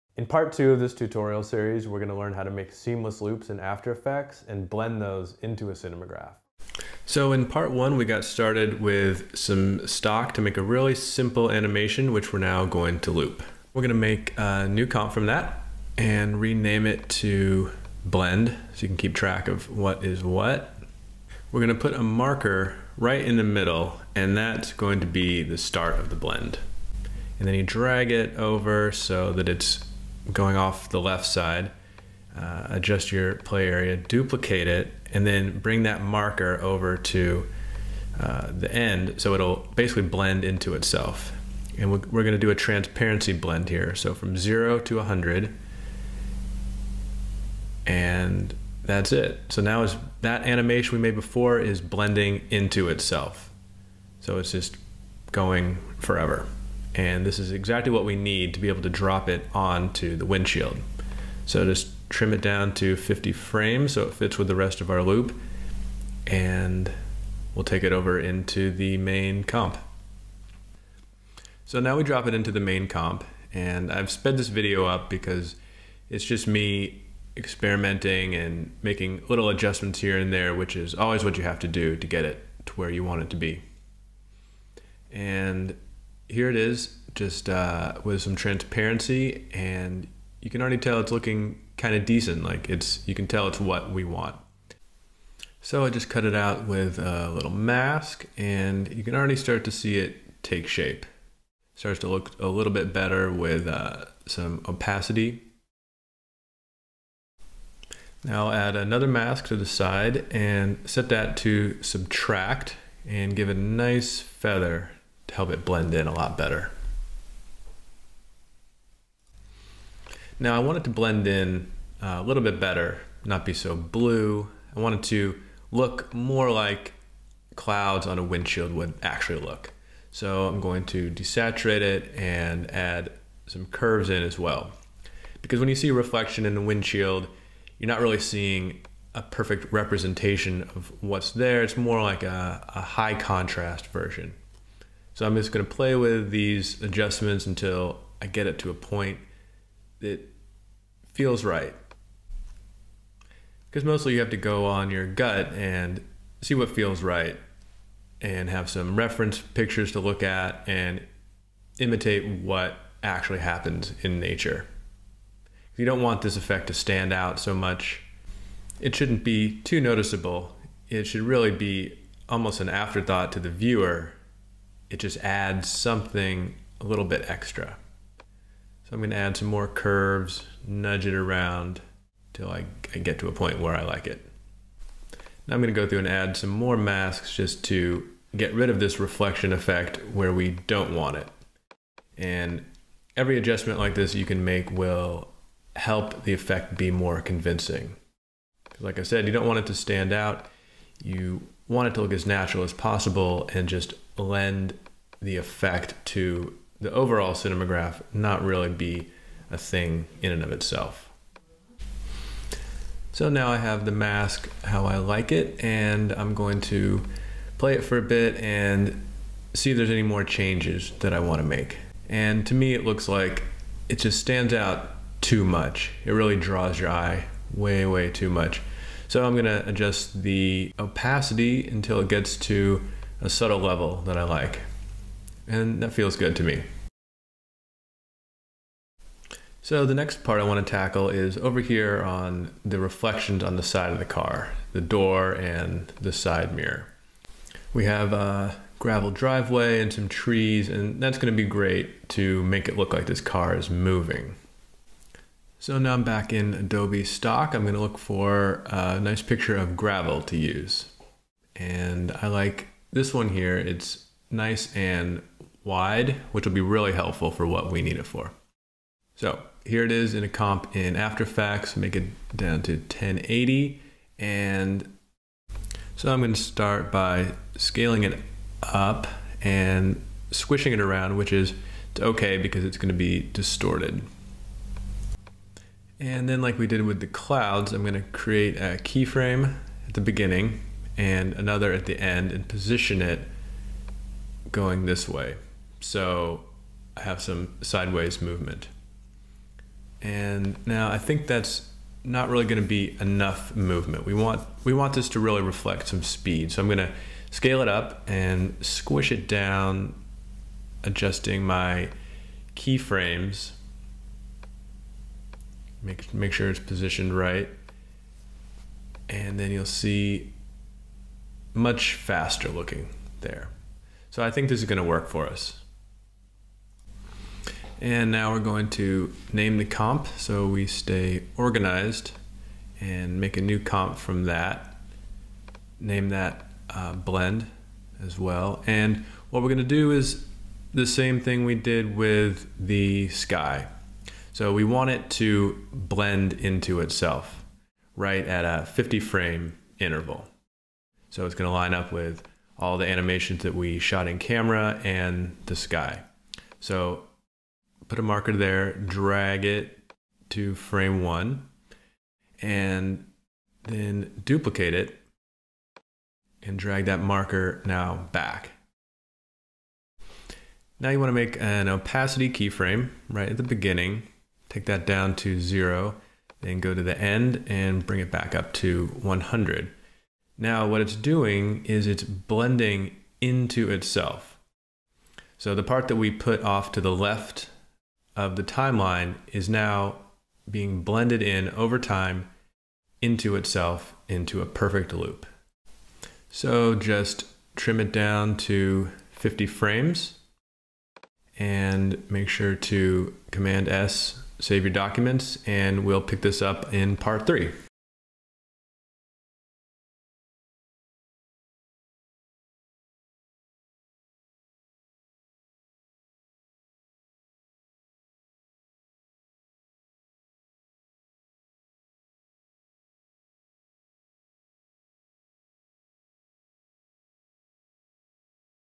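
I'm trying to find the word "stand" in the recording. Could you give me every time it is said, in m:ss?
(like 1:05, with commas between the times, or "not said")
2:46, 3:19, 3:44.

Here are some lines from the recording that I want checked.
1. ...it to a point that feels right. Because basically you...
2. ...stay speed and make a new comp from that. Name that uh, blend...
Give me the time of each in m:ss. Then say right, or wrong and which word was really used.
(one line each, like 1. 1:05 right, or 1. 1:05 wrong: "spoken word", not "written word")
1. 2:28 wrong: "mostly", not "basically"
2. 5:30 wrong: "organized", not "speed".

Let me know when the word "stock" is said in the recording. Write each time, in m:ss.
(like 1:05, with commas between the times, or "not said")
0:09, 4:17.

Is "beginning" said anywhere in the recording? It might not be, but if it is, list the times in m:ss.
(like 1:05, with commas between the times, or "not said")
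4:50, 6:13.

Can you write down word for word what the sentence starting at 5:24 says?
So I think this is going to work for us.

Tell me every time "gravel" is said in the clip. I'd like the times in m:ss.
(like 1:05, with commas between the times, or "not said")
4:08, 4:19.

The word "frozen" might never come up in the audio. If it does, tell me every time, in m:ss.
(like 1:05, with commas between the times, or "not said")
not said.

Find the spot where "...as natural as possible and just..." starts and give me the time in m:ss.
3:22.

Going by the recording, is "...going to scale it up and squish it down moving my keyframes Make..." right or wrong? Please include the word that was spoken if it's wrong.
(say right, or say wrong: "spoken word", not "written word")
wrong: "adjusting", not "moving".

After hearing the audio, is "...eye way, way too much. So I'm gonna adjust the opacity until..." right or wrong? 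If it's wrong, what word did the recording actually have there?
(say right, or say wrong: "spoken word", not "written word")
right.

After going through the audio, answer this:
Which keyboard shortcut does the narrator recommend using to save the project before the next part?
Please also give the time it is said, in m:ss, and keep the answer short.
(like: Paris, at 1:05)
Command S, at 6:43.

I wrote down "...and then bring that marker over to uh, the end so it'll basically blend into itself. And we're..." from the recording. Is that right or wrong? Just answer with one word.
right.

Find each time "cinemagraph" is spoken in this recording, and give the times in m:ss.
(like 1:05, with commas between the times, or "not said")
0:05, 3:27.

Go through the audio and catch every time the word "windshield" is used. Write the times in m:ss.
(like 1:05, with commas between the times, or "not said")
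1:00, 2:08, 2:16.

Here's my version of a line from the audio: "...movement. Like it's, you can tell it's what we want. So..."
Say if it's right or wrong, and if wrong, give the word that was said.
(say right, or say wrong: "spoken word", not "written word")
wrong: "decent", not "movement".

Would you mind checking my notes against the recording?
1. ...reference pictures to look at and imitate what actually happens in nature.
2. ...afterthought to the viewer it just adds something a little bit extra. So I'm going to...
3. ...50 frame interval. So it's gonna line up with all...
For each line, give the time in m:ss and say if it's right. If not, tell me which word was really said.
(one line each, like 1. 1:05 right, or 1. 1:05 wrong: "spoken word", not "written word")
1. 2:38 right
2. 2:52 right
3. 5:48 right.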